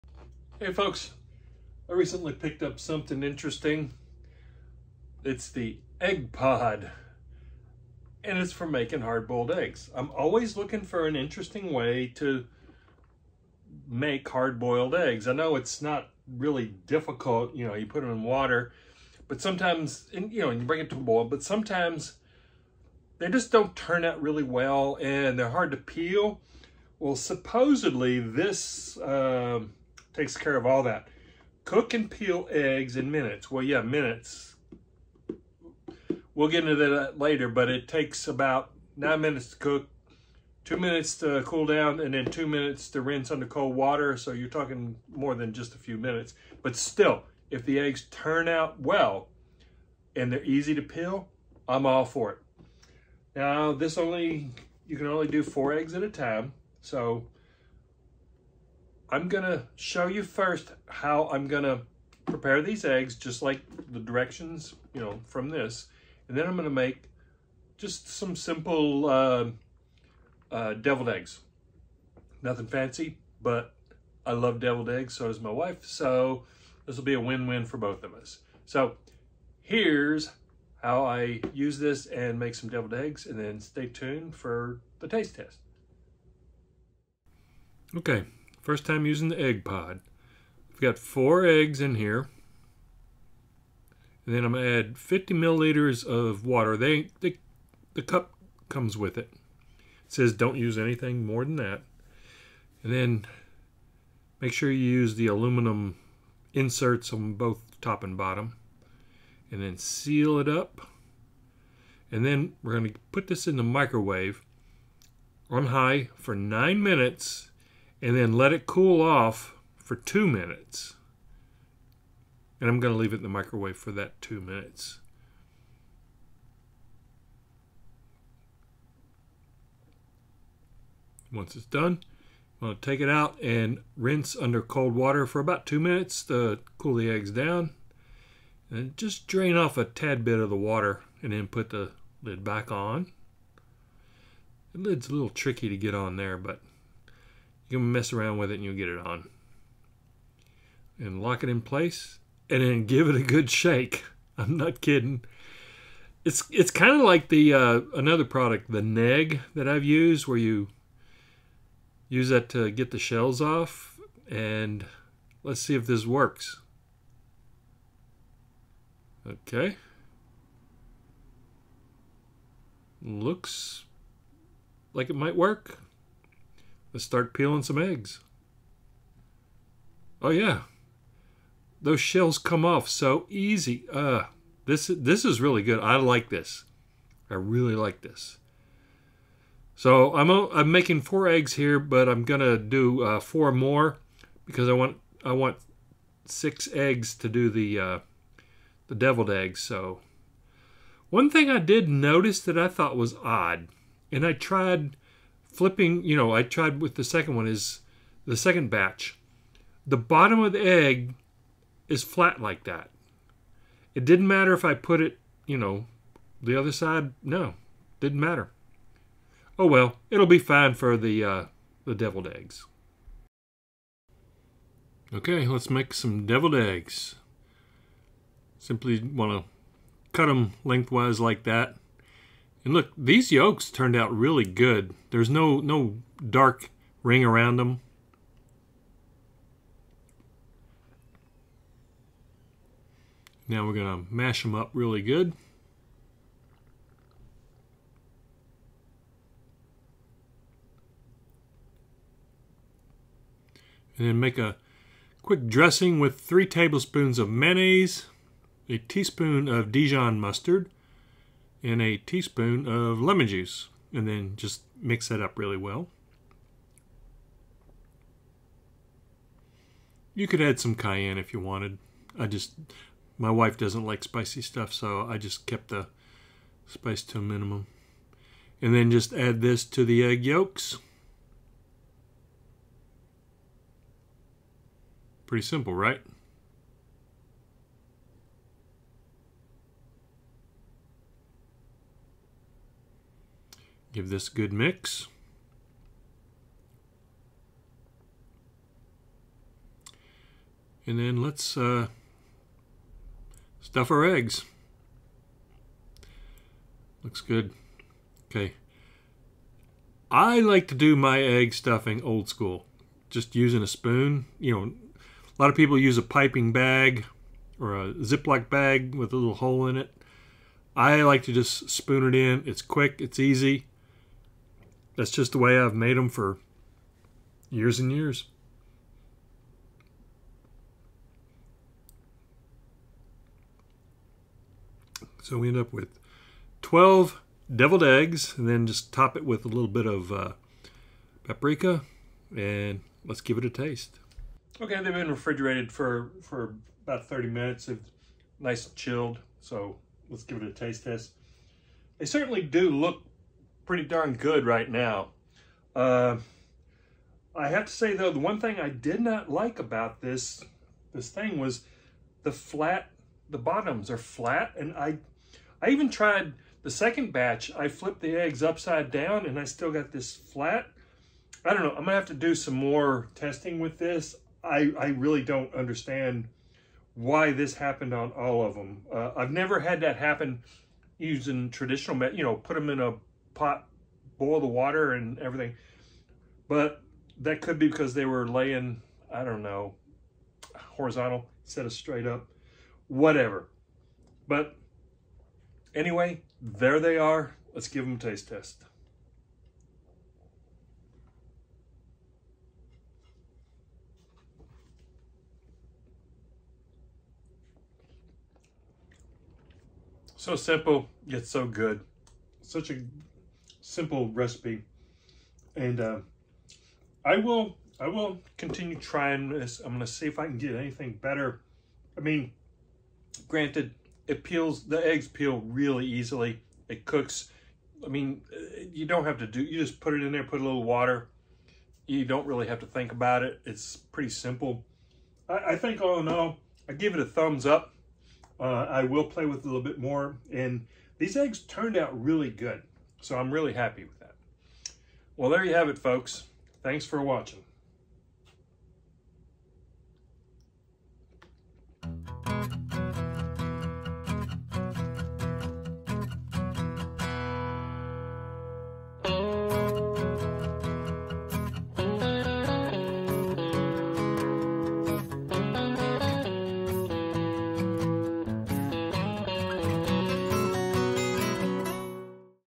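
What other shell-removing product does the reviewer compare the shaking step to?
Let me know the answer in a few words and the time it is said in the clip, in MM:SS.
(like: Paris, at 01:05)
Negg, at 02:38.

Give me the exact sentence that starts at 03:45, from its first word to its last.
Okay, let's make some deviled eggs.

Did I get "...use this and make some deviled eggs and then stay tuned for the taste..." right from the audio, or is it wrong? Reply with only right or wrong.
right.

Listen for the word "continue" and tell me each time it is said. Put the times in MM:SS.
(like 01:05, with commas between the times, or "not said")
06:58.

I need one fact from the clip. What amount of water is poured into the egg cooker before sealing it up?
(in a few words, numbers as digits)
50 milliliters.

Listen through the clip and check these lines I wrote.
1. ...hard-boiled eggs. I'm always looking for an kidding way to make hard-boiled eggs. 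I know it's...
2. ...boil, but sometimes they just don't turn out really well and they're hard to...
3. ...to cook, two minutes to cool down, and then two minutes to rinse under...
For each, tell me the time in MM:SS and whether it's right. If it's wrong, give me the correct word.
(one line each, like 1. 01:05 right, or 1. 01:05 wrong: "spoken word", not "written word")
1. 00:09 wrong: "interesting", not "kidding"
2. 00:20 right
3. 00:39 right.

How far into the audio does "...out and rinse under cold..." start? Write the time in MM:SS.
02:13.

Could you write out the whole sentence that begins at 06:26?
But that could be because they were laying, I don't know, horizontal instead of straight up, whatever.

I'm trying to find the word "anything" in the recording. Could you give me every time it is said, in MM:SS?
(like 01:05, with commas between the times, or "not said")
01:40, 07:00.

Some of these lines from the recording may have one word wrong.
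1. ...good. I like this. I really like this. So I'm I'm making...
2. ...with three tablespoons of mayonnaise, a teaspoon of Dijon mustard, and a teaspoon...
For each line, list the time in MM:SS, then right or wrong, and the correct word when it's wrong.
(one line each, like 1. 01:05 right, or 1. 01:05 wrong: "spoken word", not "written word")
1. 03:05 right
2. 04:15 right.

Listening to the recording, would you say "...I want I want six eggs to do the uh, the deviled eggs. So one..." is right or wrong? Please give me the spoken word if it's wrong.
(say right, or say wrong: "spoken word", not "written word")
right.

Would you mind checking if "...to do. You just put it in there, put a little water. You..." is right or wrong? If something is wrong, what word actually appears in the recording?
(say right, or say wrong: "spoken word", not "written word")
right.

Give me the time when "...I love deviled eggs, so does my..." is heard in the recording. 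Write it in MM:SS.
01:14.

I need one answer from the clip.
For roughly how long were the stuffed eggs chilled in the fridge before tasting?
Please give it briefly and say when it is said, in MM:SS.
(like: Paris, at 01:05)
30 minutes, at 05:47.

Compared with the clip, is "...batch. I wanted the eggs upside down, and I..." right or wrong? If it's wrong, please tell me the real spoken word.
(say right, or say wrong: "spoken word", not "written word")
wrong: "flipped", not "wanted".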